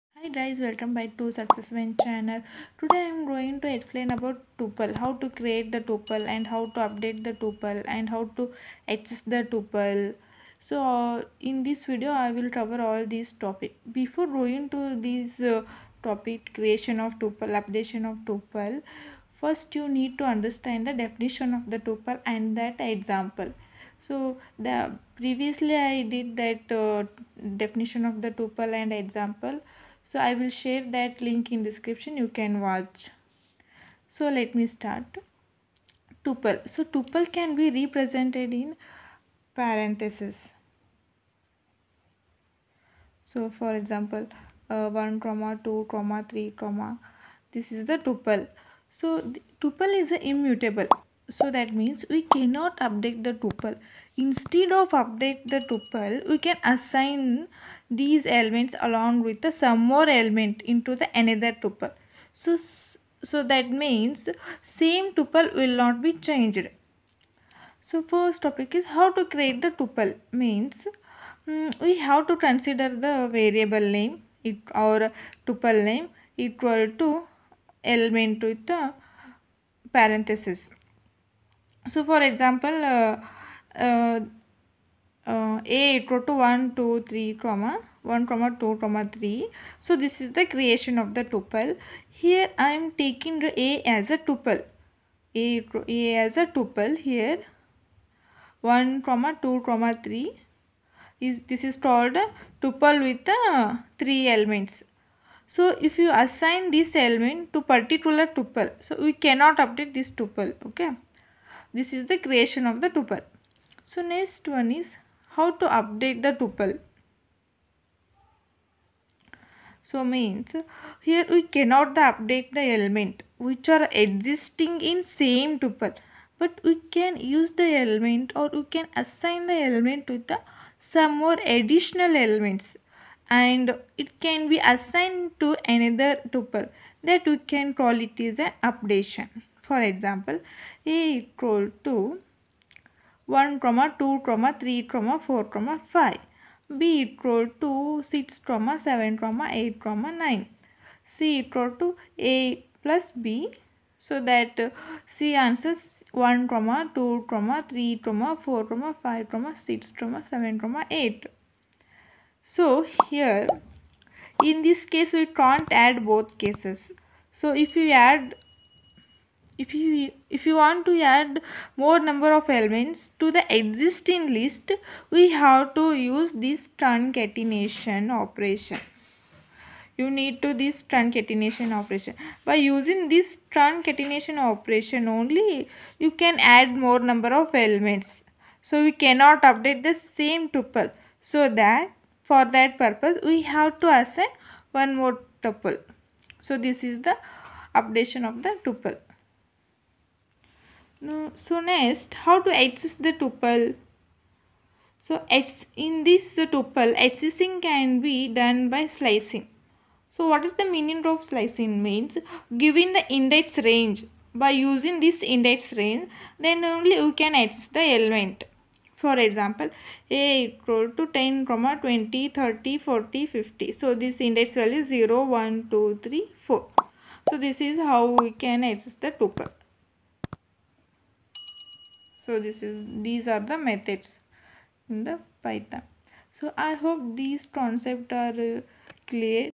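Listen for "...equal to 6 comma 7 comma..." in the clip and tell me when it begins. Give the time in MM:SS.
02:27.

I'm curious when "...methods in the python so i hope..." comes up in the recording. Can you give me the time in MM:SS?
03:53.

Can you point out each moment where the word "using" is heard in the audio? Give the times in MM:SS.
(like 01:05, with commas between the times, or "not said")
03:02, 03:34.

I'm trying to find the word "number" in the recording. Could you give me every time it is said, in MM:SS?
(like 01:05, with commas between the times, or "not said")
02:52, 03:07.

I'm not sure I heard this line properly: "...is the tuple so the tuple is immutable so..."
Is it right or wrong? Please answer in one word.
right.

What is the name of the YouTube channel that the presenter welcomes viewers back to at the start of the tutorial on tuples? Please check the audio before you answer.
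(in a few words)
Success Win.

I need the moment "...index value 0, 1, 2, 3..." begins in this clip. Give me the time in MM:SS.
03:44.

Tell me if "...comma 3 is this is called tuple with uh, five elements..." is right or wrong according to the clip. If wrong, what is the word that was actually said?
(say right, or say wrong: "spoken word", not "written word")
wrong: "three", not "five".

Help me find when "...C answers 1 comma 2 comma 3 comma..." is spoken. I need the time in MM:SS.
02:35.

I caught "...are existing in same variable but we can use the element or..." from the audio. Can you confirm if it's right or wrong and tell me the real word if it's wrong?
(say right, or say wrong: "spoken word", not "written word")
wrong: "tuple", not "variable".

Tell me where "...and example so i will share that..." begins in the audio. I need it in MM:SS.
00:28.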